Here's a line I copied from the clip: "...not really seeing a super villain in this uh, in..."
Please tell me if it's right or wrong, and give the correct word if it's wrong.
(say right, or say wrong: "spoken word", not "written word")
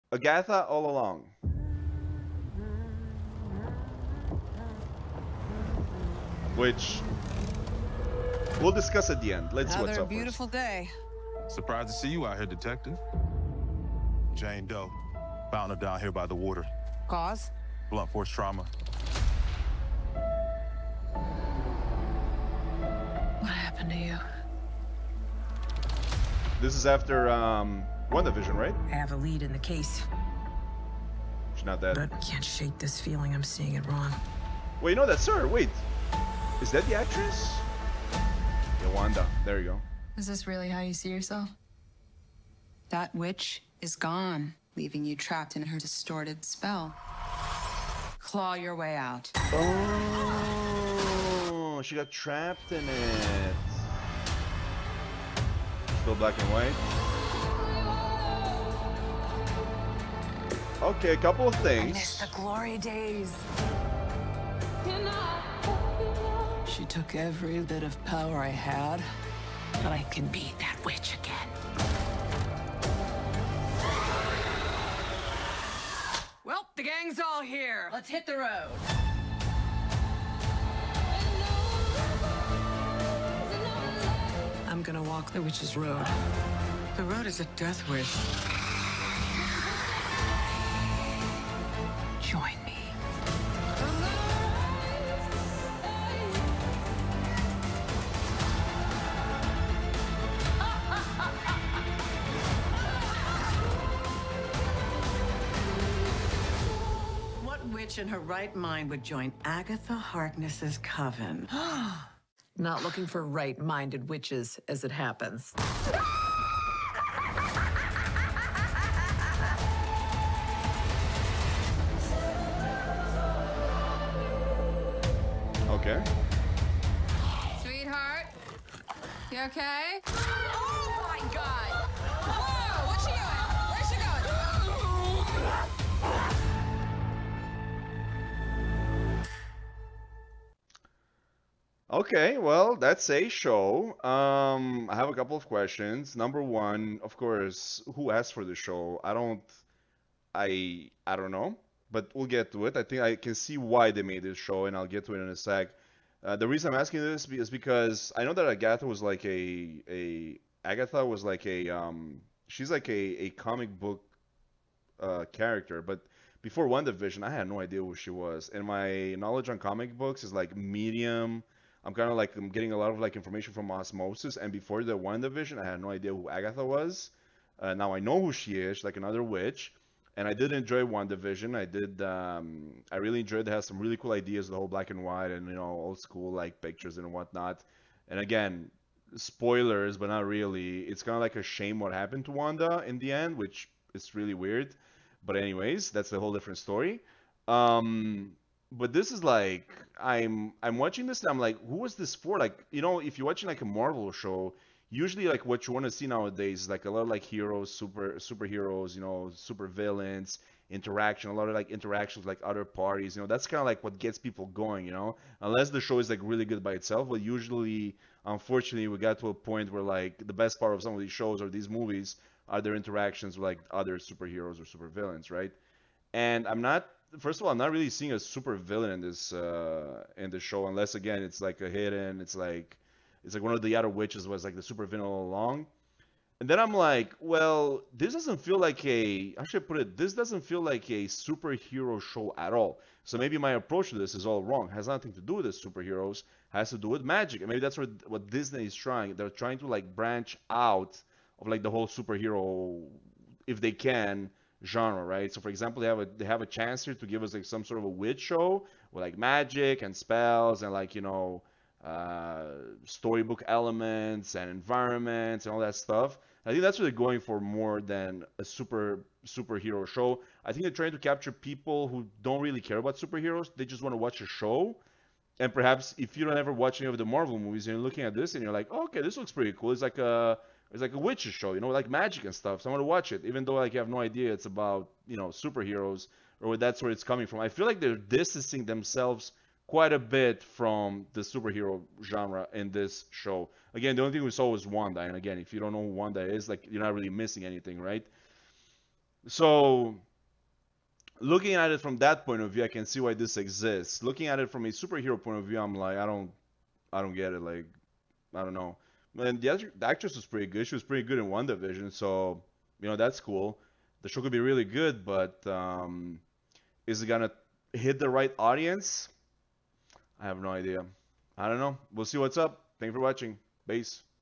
right.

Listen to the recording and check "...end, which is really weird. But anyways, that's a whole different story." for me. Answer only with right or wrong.
right.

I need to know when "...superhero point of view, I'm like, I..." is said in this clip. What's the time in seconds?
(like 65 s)
304 s.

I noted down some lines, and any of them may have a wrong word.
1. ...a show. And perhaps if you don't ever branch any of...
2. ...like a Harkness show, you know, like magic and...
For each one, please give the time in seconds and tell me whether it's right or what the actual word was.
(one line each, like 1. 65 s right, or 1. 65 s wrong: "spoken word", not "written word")
1. 274 s wrong: "watch", not "branch"
2. 280 s wrong: "Witcher", not "Harkness".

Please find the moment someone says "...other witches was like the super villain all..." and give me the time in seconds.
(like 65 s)
233 s.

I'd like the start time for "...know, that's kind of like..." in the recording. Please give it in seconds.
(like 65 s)
213 s.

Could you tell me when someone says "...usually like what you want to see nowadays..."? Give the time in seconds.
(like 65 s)
204 s.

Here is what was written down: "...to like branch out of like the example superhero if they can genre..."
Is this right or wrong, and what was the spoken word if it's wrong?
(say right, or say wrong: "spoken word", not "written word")
wrong: "whole", not "example".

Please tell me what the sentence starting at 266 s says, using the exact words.
I think that's what they're going for more than a super superhero show.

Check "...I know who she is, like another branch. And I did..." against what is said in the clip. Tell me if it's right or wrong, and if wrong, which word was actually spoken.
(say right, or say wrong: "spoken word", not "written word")
wrong: "witch", not "branch".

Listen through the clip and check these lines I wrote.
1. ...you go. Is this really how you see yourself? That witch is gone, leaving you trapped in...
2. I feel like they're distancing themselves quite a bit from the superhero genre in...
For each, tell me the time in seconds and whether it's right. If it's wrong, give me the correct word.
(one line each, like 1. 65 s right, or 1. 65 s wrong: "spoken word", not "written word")
1. 39 s right
2. 287 s right.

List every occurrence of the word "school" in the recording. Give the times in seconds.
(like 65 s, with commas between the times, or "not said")
185 s.